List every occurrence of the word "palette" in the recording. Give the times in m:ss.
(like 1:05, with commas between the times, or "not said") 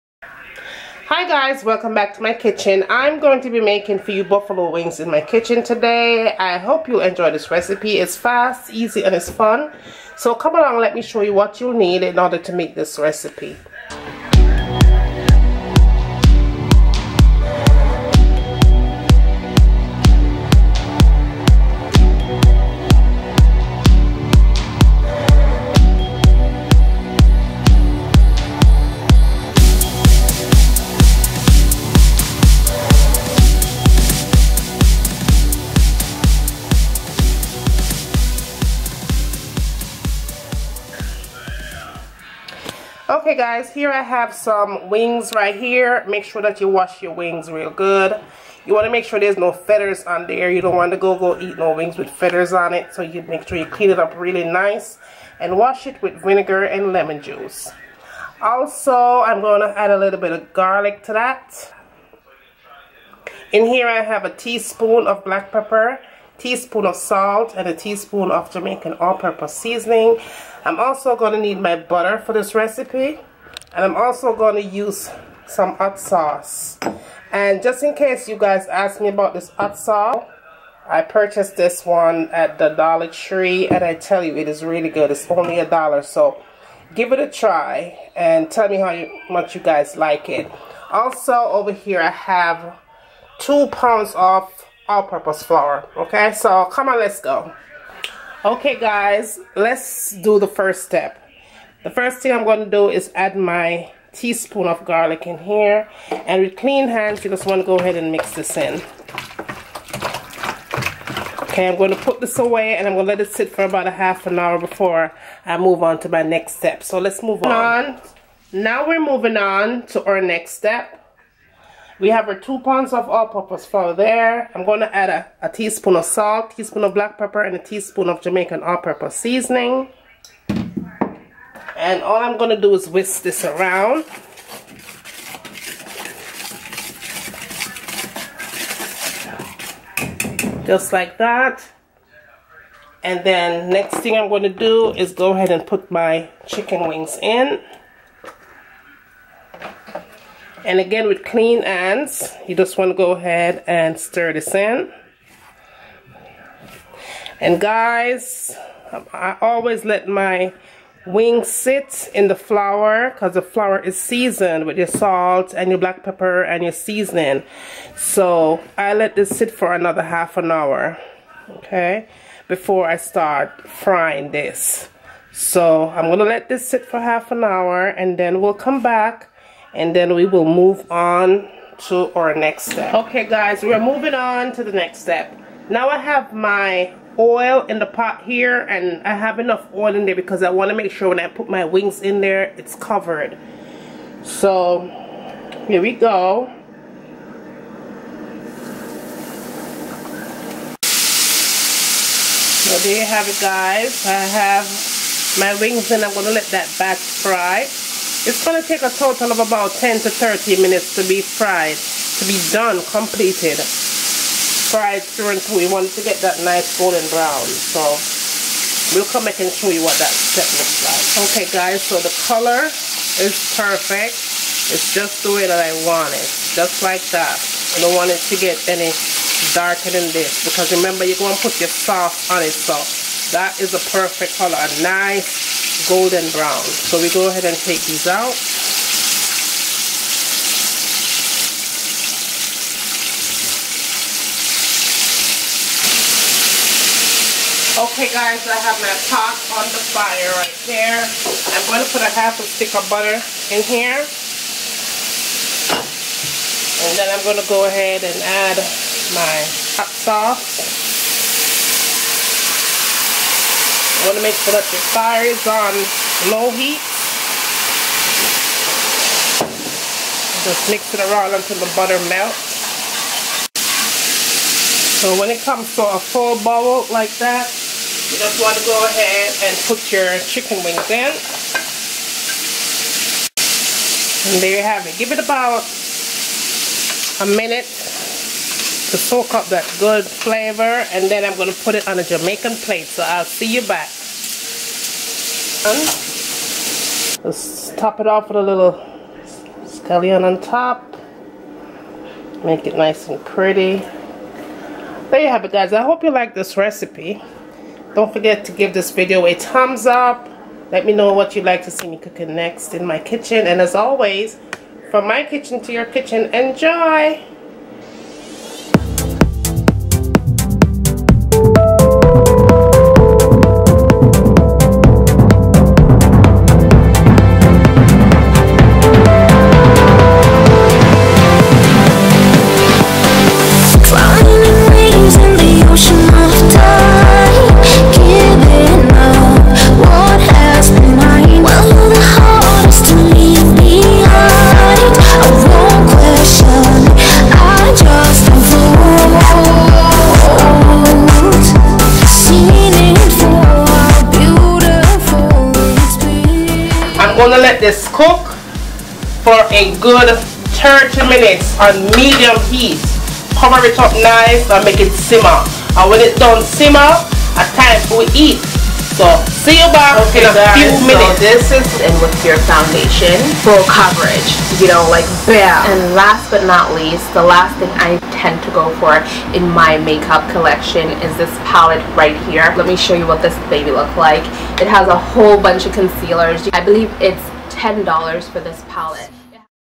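6:21, 6:28.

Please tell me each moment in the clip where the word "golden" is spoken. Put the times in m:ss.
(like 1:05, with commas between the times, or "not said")
3:36, 3:55.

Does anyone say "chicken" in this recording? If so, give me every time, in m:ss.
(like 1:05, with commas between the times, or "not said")
2:26, 4:40.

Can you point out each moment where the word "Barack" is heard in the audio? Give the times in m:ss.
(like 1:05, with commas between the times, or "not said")
not said.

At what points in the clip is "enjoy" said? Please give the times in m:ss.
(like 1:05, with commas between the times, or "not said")
0:07, 5:16.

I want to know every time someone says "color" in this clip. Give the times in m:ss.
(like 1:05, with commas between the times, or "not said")
3:42, 3:54.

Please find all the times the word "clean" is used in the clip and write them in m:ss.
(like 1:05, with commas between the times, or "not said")
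0:53, 1:46, 2:31.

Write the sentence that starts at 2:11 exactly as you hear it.
And all I'm going to do is whisk this around.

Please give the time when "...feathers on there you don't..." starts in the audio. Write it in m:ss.
0:49.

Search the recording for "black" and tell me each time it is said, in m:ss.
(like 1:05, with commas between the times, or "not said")
1:05, 2:06, 2:45.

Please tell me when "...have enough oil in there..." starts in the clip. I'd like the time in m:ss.
3:09.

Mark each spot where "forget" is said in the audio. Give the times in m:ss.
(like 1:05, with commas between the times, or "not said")
5:08.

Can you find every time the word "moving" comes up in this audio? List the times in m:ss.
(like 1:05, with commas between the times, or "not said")
1:58, 3:03.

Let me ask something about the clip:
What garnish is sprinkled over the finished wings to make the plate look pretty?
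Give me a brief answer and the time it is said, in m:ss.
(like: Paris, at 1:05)
scallion, at 4:59.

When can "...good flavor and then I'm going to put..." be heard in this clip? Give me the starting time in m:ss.
4:49.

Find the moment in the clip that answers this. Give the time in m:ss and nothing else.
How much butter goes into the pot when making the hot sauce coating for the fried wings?
4:12.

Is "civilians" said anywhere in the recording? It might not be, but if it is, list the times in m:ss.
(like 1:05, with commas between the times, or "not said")
not said.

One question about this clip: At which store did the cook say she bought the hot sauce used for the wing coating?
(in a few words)
Dollar Tree.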